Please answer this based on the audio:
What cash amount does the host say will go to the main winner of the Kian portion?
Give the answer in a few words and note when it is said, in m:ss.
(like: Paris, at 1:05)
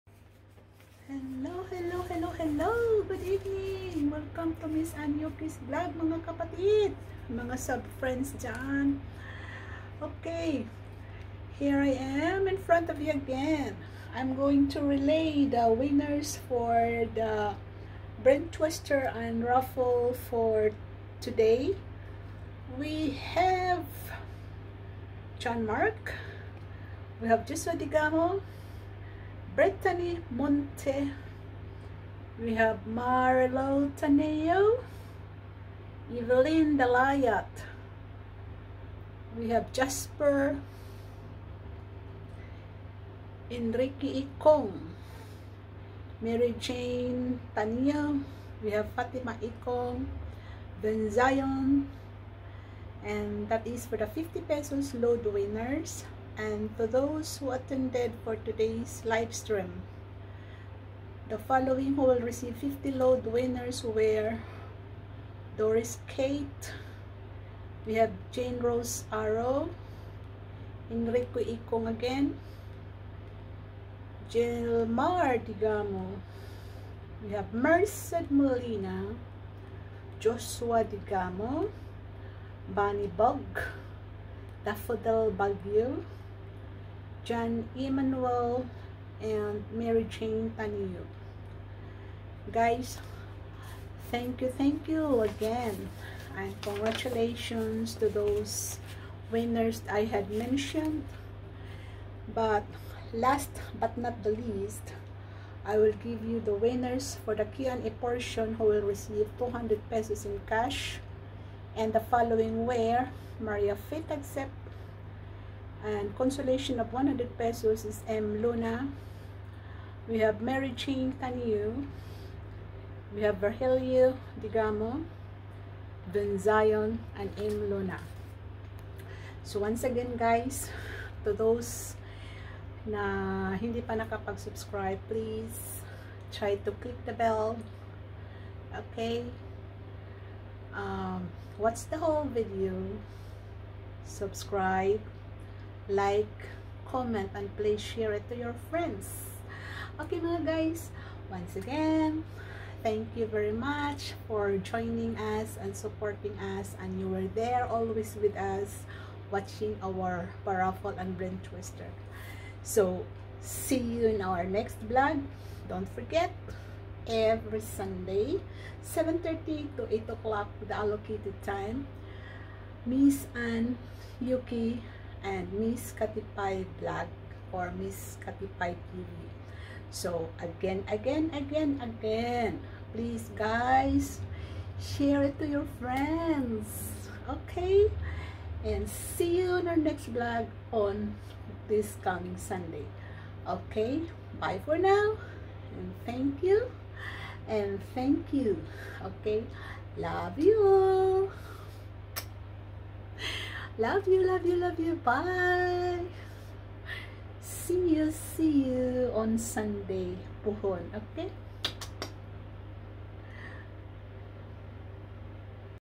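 200 pesos, at 1:49.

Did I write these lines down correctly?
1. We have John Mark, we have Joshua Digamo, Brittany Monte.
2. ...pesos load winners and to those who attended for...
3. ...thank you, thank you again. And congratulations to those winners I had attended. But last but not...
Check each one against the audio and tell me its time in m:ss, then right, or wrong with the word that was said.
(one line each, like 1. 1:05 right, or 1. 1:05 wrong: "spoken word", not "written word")
1. 0:22 right
2. 0:54 right
3. 1:34 wrong: "mentioned", not "attended".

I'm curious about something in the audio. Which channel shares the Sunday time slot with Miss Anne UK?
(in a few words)
Miss Katipay TV.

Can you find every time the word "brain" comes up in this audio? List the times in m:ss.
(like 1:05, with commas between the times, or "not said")
0:18, 2:41.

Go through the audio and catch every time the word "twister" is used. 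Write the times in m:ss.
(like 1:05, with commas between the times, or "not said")
0:18, 2:41.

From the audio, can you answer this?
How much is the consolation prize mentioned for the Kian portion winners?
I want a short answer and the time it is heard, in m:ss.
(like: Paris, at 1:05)
100 pesos, at 1:56.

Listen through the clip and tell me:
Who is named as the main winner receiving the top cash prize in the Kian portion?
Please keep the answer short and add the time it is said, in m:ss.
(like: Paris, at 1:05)
Maria Faith, at 1:53.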